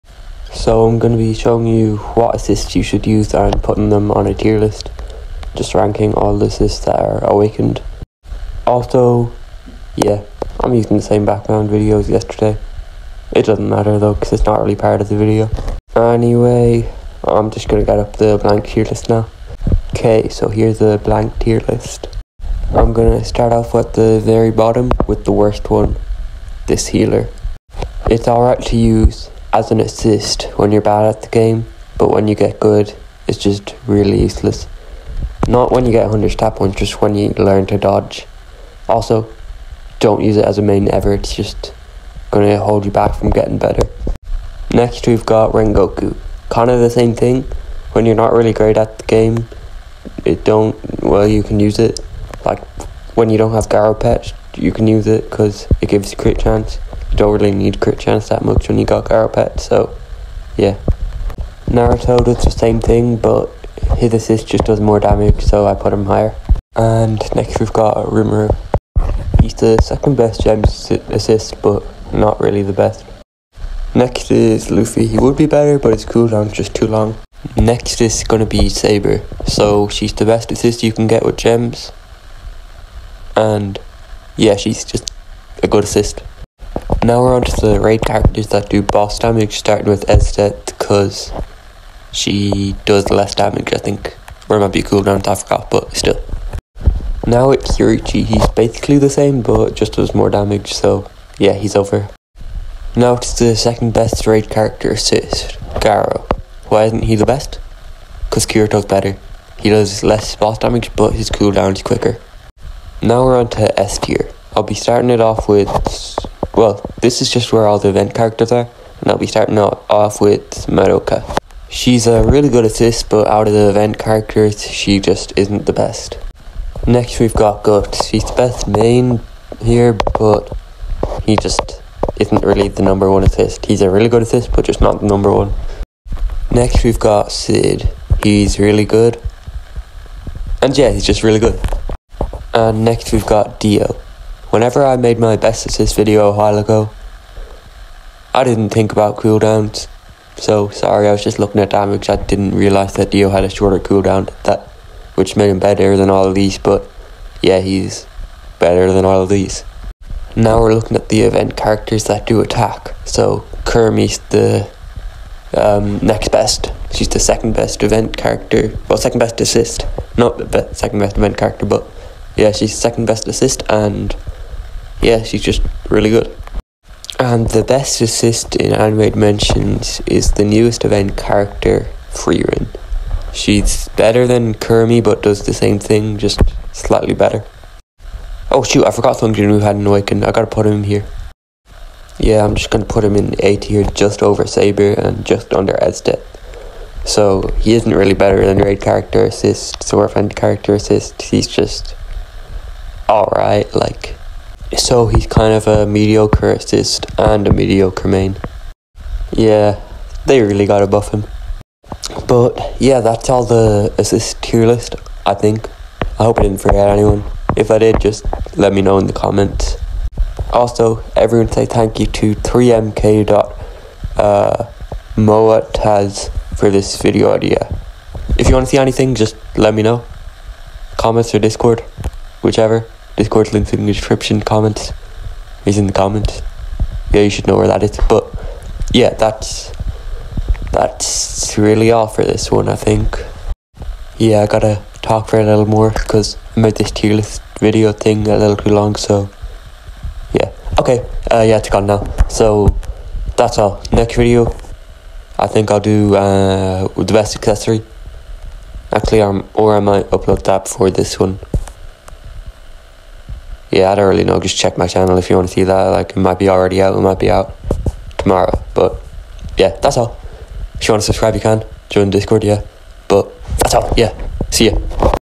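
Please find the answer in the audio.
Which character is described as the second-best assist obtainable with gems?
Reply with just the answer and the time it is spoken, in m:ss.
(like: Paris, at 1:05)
Rimuru, at 1:08.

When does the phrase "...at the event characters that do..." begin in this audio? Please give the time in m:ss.
2:40.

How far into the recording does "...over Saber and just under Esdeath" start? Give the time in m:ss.
3:14.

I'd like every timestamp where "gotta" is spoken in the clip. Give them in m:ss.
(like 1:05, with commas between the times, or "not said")
3:10, 4:04.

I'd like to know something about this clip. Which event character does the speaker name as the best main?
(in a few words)
Guts.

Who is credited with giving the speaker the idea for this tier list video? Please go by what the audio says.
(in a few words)
3mk.moataz.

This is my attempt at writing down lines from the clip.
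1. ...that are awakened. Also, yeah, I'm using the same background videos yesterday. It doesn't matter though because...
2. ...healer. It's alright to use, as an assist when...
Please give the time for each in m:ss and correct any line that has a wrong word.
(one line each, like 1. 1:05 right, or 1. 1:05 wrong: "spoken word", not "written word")
1. 0:06 right
2. 0:26 right.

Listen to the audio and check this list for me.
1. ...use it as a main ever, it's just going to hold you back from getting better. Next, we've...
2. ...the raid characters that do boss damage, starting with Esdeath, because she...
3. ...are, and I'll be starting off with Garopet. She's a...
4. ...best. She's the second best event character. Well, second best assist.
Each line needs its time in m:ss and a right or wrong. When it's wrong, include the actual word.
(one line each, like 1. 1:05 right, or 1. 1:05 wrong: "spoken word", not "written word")
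1. 0:40 right
2. 1:27 right
3. 1:58 wrong: "Madoka", not "Garopet"
4. 2:46 right.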